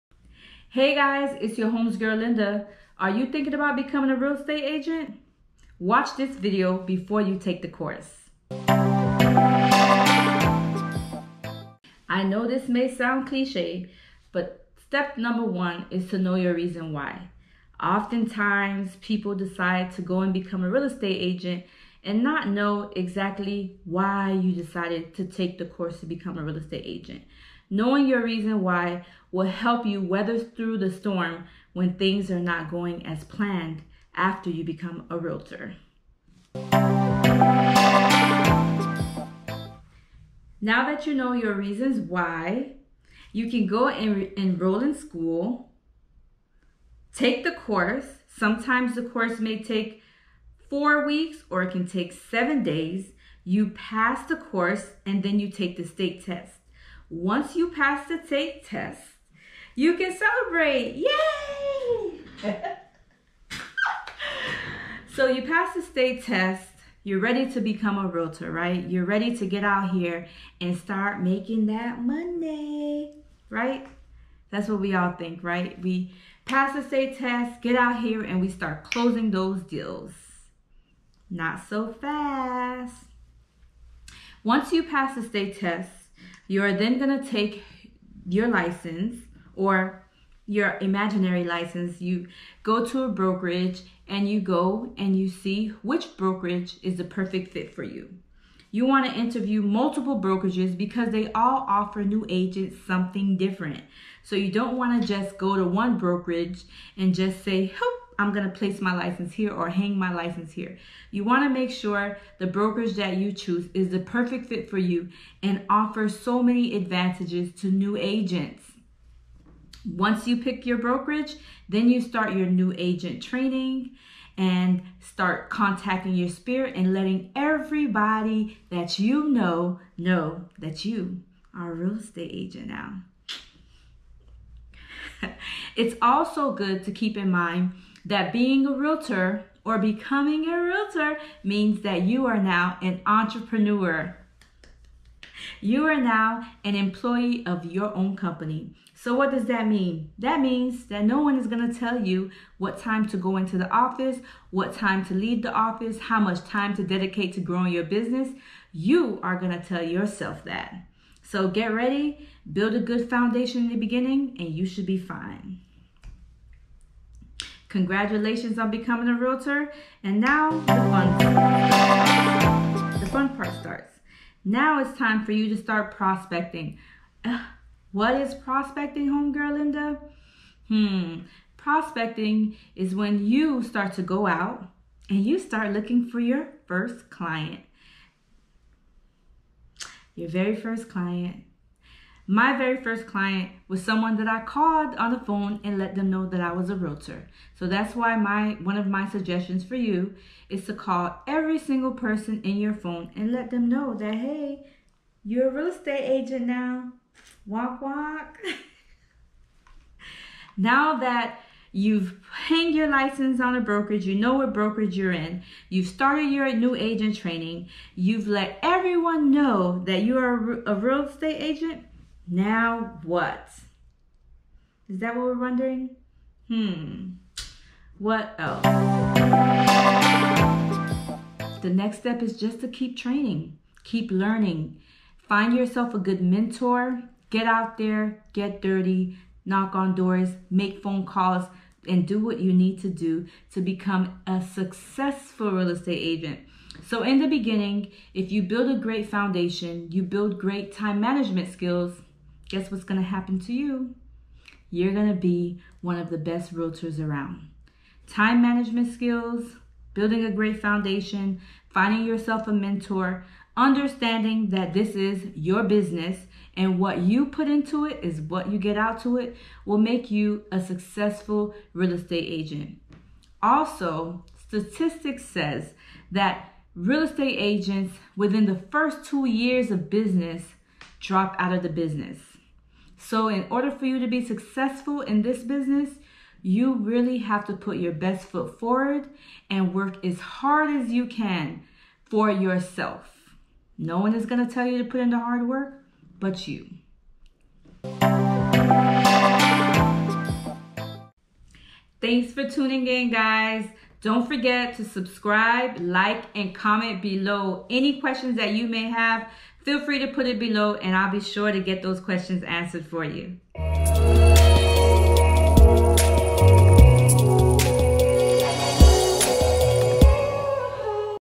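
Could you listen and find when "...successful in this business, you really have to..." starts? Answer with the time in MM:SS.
04:44.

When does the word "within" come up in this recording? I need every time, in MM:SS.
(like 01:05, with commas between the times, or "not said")
04:38.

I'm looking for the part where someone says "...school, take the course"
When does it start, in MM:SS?
00:44.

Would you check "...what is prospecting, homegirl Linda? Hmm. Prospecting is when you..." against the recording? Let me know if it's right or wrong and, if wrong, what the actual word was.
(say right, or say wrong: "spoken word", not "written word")
right.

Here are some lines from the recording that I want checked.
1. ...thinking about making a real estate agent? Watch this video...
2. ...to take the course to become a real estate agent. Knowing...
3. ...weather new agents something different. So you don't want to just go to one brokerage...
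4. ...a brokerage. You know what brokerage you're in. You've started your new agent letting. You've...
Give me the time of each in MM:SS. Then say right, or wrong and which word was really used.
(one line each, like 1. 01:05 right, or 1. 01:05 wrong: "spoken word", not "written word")
1. 00:03 wrong: "becoming", not "making"
2. 00:25 right
3. 01:41 wrong: "offer", not "weather"
4. 03:33 wrong: "training", not "letting".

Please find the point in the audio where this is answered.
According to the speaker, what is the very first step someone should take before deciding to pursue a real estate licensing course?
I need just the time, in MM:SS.
00:16.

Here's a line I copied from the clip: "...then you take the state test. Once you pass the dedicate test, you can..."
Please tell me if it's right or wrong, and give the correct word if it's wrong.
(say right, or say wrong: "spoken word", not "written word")
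wrong: "state", not "dedicate".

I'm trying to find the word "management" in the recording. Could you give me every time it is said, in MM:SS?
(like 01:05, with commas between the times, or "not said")
04:10, 04:18.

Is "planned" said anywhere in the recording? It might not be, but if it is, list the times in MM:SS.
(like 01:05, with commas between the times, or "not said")
00:33.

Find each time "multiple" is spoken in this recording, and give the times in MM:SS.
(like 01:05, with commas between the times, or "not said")
01:39.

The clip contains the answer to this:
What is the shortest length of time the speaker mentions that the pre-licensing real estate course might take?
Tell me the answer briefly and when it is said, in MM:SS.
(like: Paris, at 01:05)
7 days, at 00:52.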